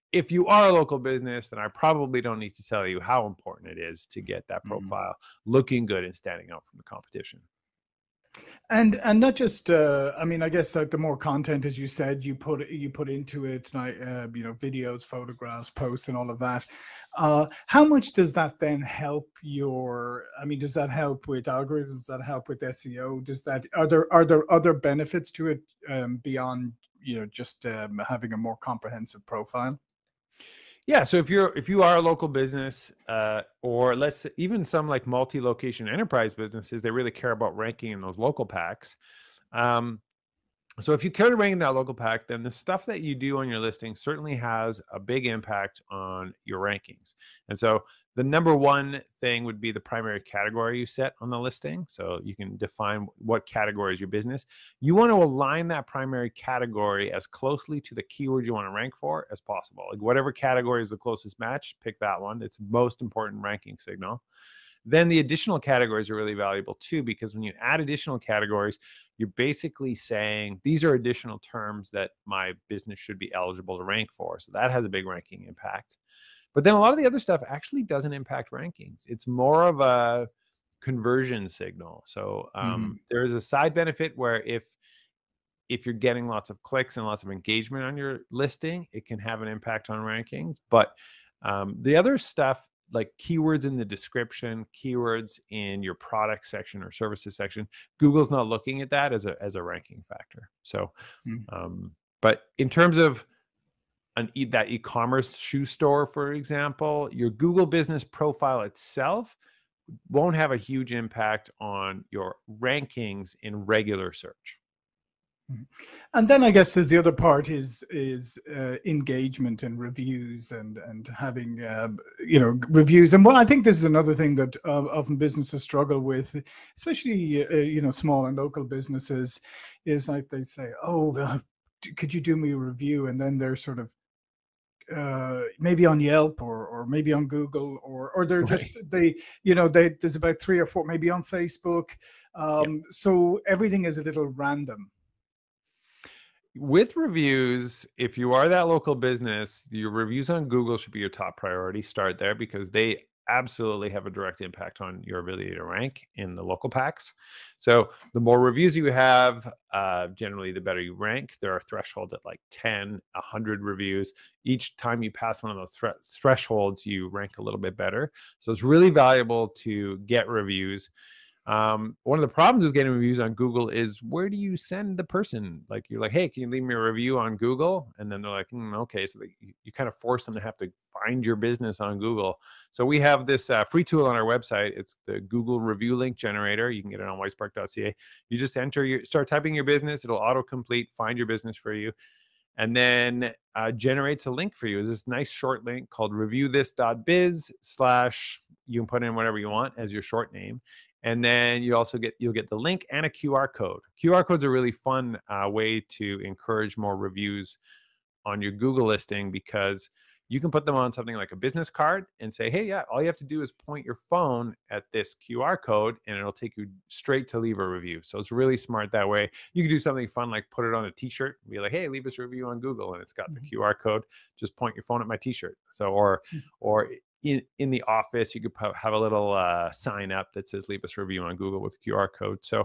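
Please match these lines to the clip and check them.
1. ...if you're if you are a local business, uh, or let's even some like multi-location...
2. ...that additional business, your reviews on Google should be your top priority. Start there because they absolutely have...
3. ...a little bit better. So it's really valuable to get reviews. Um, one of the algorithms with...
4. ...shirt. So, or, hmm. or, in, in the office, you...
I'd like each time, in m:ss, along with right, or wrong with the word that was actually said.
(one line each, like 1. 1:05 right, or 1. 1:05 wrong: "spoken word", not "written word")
1. 0:31 right
2. 2:28 wrong: "local", not "additional"
3. 2:47 wrong: "problems", not "algorithms"
4. 3:45 right.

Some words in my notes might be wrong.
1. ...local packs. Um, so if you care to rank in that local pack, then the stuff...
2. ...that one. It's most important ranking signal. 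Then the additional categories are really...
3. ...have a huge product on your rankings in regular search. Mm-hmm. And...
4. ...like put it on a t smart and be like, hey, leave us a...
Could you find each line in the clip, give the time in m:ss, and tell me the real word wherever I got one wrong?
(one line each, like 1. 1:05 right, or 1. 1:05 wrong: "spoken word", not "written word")
1. 0:38 right
2. 1:01 right
3. 1:50 wrong: "impact", not "product"
4. 3:40 wrong: "shirt", not "smart".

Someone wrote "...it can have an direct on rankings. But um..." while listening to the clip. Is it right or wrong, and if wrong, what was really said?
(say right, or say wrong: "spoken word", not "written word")
wrong: "impact", not "direct".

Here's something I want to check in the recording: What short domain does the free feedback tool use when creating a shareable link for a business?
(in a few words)
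reviewthis.biz.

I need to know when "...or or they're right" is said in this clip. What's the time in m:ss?
2:17.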